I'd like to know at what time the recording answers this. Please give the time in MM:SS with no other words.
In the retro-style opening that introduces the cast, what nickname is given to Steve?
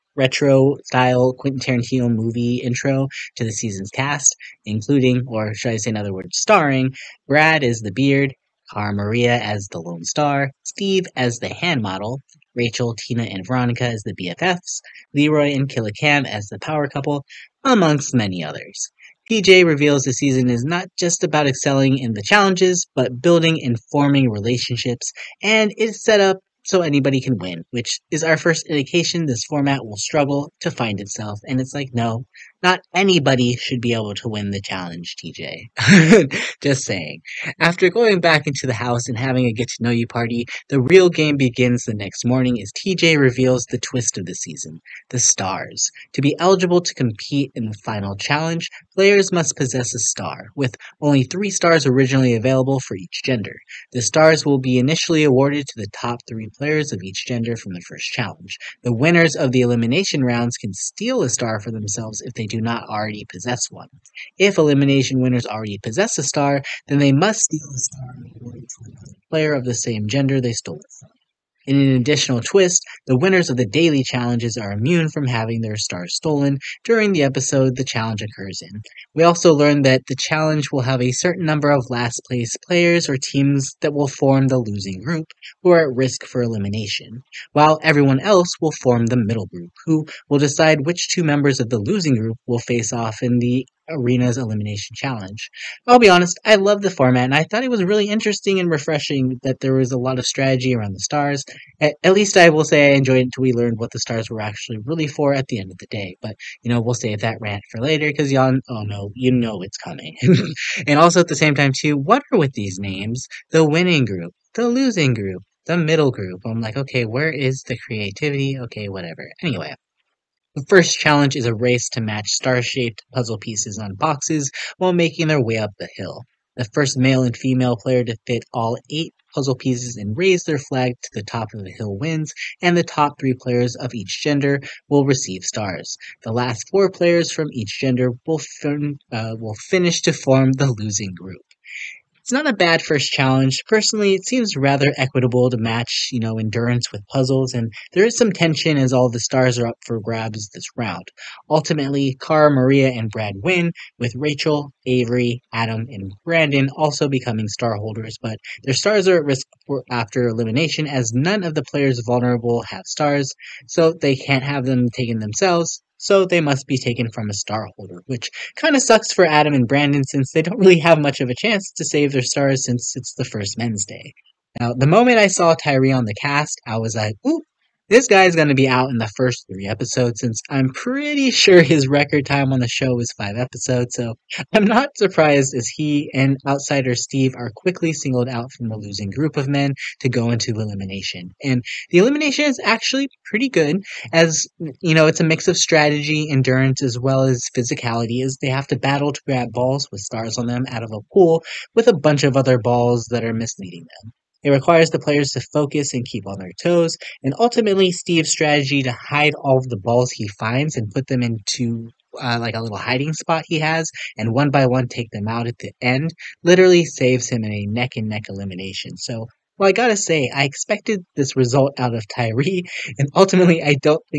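00:11.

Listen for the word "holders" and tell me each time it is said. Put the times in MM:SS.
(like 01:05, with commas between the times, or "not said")
02:37, 02:47.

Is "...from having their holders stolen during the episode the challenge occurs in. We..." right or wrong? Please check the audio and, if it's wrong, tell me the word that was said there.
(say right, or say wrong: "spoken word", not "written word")
wrong: "stars", not "holders".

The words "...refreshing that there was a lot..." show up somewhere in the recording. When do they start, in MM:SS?
01:38.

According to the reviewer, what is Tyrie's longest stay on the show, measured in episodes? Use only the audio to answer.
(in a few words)
5 episodes.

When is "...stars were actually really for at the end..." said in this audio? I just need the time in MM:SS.
01:43.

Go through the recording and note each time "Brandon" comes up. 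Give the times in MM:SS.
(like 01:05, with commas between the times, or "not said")
02:36, 02:49.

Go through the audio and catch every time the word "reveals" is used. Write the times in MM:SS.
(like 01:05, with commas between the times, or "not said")
00:19, 00:43.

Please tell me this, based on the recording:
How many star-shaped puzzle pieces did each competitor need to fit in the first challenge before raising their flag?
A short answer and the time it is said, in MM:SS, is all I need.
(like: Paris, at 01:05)
8, at 02:08.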